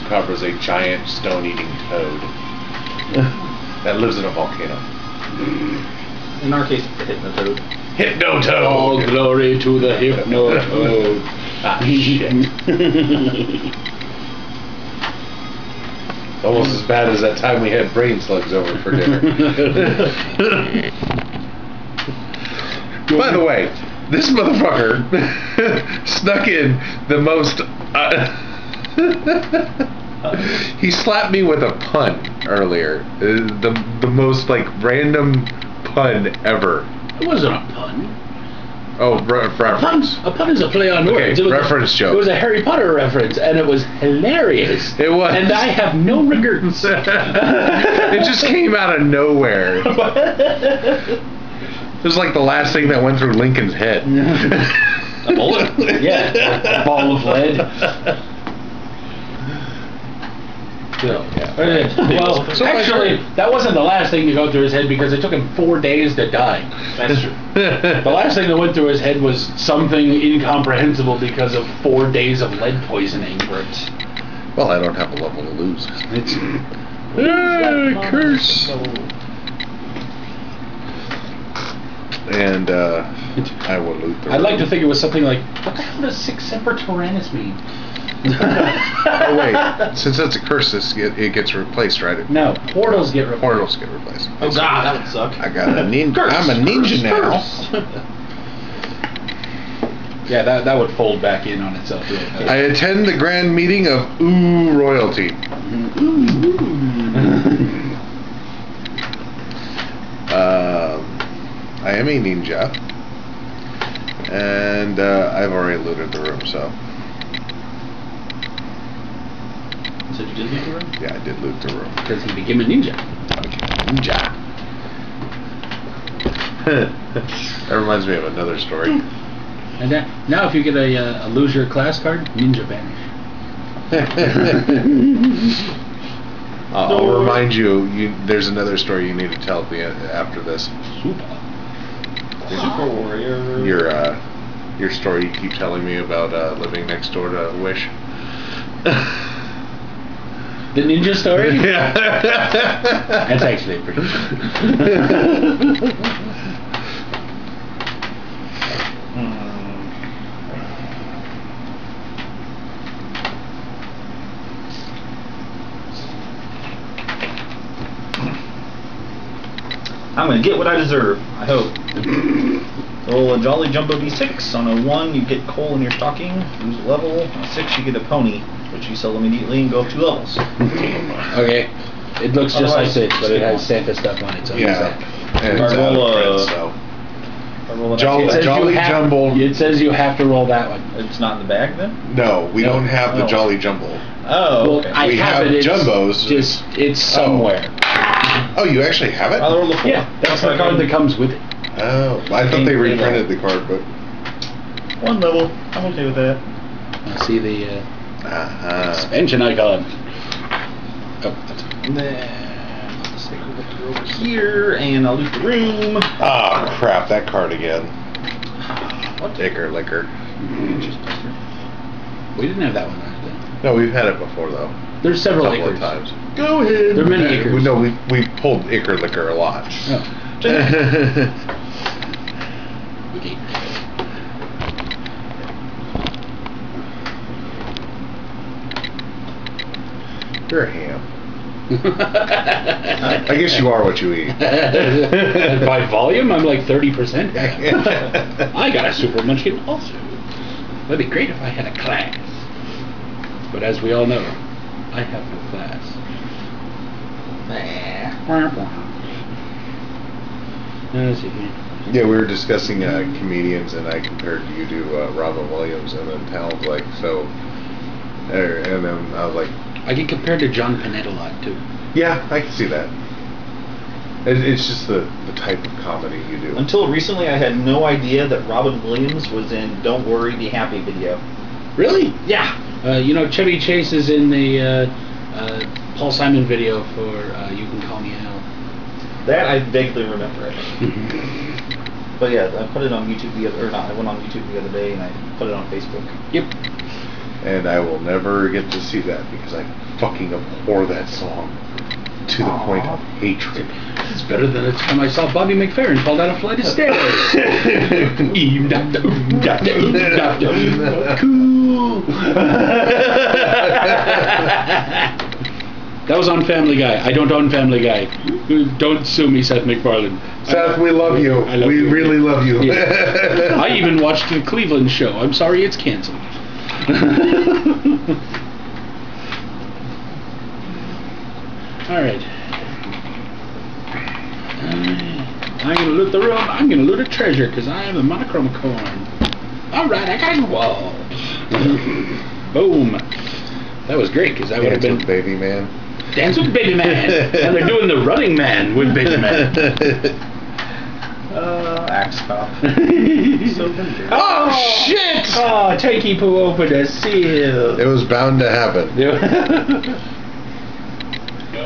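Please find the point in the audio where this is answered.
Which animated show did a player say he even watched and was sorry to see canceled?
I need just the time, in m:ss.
5:24.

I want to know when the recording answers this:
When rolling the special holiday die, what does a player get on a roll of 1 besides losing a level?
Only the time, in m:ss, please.
2:55.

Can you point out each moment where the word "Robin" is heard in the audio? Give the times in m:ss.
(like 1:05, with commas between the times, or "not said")
4:25, 4:38.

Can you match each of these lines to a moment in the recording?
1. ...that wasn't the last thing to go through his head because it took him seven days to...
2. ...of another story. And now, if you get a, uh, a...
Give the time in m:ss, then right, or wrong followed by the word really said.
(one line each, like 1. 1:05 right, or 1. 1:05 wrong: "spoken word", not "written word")
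1. 1:03 wrong: "four", not "seven"
2. 2:08 right.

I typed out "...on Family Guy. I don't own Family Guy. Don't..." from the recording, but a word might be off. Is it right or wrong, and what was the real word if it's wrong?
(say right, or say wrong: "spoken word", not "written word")
right.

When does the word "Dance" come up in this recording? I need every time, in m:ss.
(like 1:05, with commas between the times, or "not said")
5:46.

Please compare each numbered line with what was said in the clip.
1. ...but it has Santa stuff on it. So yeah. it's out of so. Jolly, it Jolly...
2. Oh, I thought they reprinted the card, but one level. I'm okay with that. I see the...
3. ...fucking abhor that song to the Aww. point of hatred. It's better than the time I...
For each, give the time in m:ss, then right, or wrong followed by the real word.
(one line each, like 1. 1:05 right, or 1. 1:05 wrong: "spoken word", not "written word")
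1. 3:03 right
2. 3:21 right
3. 4:59 right.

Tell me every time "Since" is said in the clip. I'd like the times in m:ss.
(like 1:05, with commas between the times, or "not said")
1:29.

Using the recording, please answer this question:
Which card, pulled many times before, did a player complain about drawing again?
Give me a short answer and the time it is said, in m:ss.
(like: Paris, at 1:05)
Icker Liquor, at 3:48.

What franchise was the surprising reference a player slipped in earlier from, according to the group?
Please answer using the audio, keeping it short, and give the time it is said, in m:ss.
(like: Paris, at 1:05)
Harry Potter, at 0:42.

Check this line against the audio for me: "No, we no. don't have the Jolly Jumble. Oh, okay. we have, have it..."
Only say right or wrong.
right.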